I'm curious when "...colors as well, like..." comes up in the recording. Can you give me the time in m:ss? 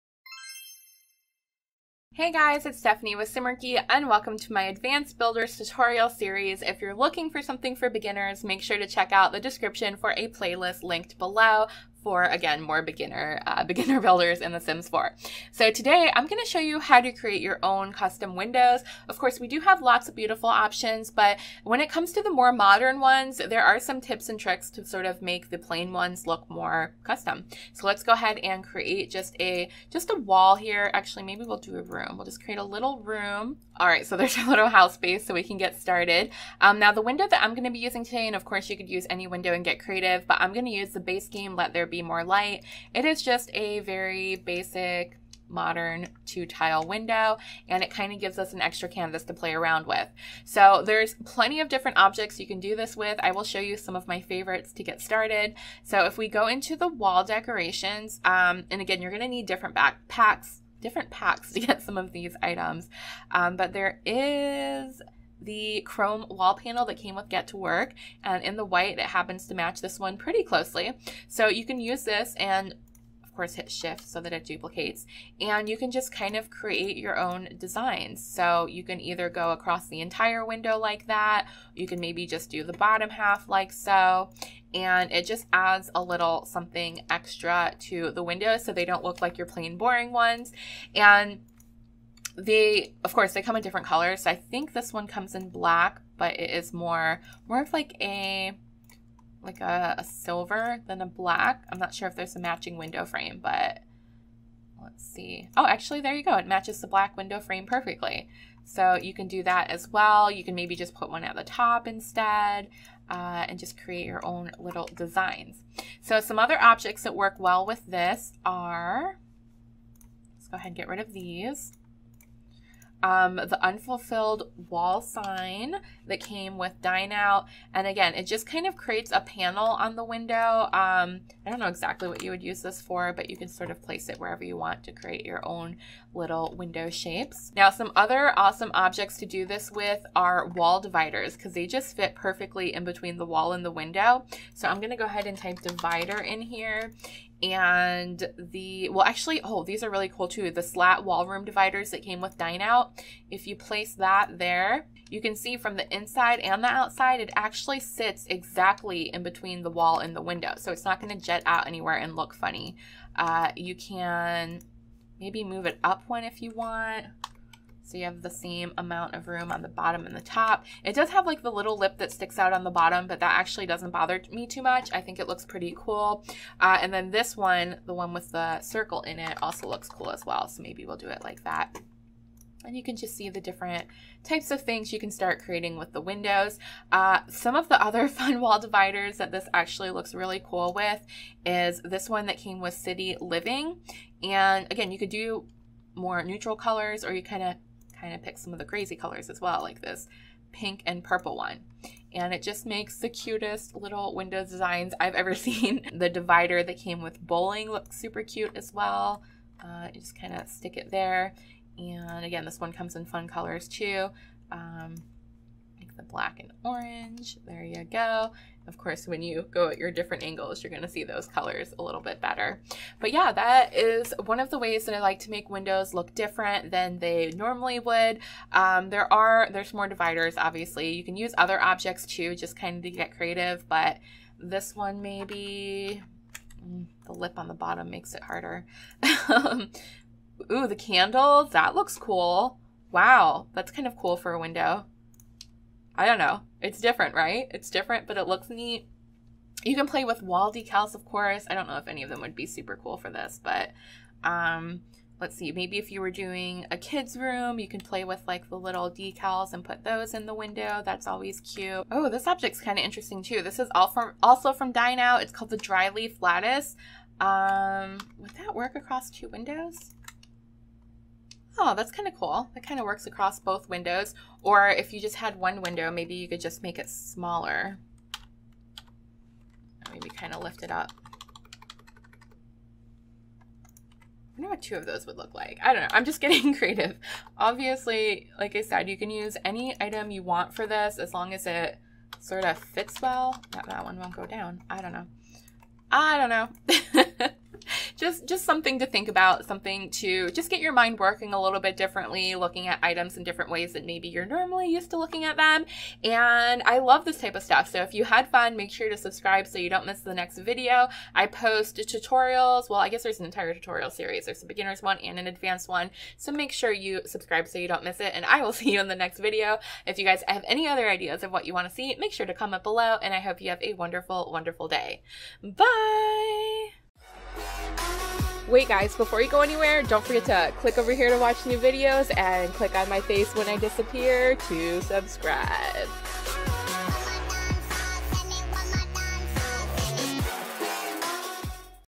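3:18.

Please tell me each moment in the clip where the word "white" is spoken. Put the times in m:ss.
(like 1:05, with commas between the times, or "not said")
1:08.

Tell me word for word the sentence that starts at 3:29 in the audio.
Uh, you just kind of stick it there.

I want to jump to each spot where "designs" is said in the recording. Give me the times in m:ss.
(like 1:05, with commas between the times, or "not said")
1:17, 1:54, 3:24.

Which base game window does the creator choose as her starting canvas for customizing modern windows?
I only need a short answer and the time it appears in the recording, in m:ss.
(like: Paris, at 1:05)
Let There be more light, at 0:41.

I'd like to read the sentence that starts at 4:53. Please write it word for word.
That, that one won't go down.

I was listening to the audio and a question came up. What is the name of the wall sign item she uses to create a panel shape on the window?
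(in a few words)
unfulfilled wall sign.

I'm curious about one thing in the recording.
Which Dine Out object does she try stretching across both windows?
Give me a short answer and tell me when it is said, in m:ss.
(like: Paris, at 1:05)
dry leaf lattice, at 4:25.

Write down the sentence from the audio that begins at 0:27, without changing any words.
So let's go ahead and create just a, just a wall here.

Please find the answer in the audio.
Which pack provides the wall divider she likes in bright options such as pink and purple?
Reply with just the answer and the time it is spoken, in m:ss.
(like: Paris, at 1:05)
City Living, at 3:12.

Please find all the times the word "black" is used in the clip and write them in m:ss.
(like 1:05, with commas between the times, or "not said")
1:35, 1:41, 1:46, 3:36.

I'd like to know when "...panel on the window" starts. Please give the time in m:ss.
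2:09.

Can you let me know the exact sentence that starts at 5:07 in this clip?
So if you had fun, make sure to subscribe so you don't miss the next video.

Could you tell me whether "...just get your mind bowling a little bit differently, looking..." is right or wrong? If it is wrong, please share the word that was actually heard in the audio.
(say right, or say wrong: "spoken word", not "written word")
wrong: "working", not "bowling".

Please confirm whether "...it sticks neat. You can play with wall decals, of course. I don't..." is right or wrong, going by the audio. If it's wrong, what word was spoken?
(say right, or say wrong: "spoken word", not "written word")
wrong: "looks", not "sticks".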